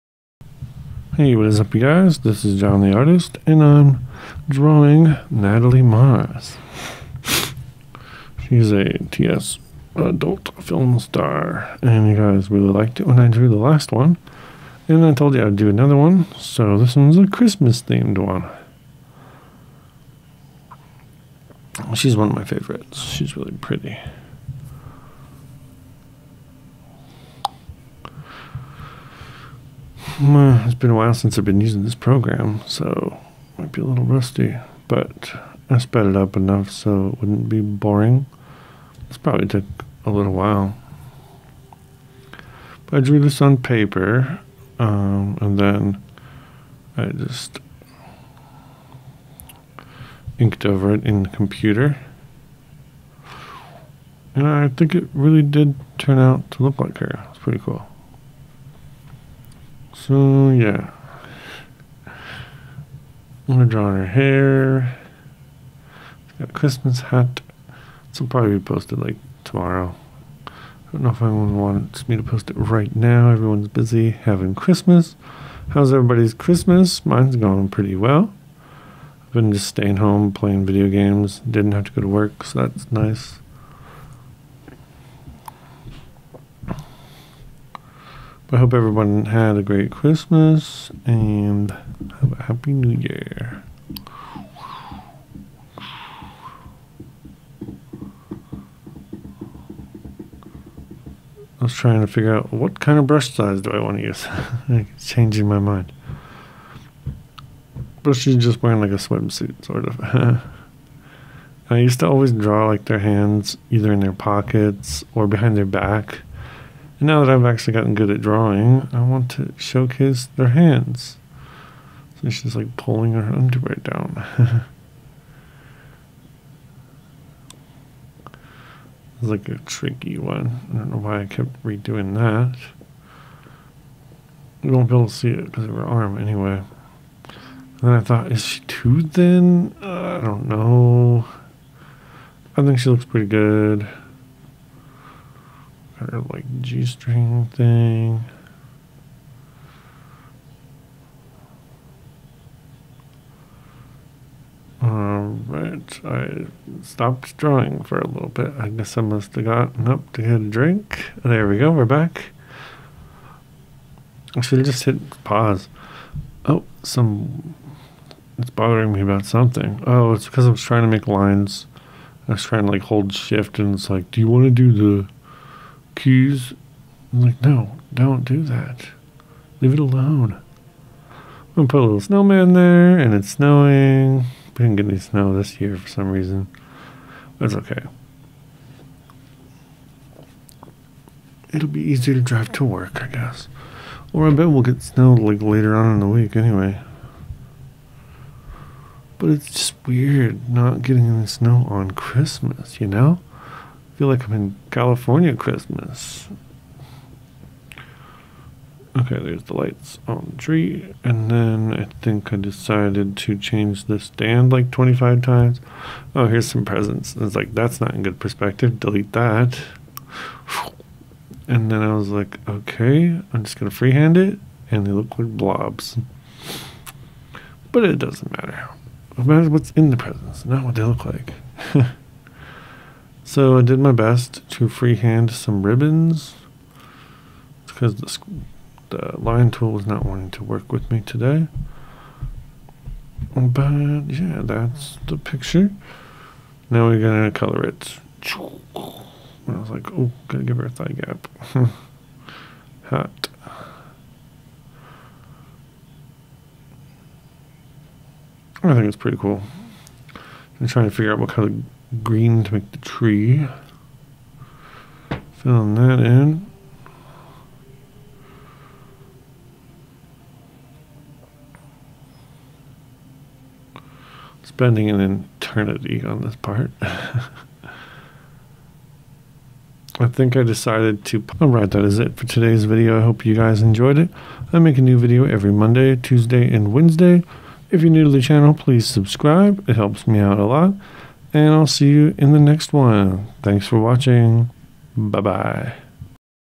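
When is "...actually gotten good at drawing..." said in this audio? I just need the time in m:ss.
1:57.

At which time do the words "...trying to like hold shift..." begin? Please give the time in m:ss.
2:52.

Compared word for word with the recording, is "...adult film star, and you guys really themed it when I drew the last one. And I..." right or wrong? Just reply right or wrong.
wrong.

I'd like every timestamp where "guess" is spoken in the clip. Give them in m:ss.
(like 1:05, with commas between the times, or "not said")
2:38, 3:13.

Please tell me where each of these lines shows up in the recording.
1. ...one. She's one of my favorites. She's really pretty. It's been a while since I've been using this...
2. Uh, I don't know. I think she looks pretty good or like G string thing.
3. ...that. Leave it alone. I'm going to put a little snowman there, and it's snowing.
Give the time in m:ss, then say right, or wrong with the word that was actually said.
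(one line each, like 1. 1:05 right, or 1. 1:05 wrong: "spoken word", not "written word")
1. 0:18 right
2. 2:19 right
3. 2:58 right.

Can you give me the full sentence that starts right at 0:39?
This probably took a little while.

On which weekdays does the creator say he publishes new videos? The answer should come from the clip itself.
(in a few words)
Monday, Tuesday, and Wednesday.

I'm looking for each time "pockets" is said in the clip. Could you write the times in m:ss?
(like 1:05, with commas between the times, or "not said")
1:54.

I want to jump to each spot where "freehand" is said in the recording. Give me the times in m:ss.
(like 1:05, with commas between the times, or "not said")
3:43, 3:54.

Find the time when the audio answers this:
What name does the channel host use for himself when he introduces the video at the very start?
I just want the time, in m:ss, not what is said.
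0:02.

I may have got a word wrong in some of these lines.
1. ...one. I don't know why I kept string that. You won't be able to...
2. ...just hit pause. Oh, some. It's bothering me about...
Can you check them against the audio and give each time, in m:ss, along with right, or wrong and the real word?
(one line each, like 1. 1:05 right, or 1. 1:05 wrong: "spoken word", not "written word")
1. 2:10 wrong: "redoing", not "string"
2. 2:44 right.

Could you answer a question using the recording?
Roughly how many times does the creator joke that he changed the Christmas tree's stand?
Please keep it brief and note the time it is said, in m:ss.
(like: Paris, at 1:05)
25, at 3:34.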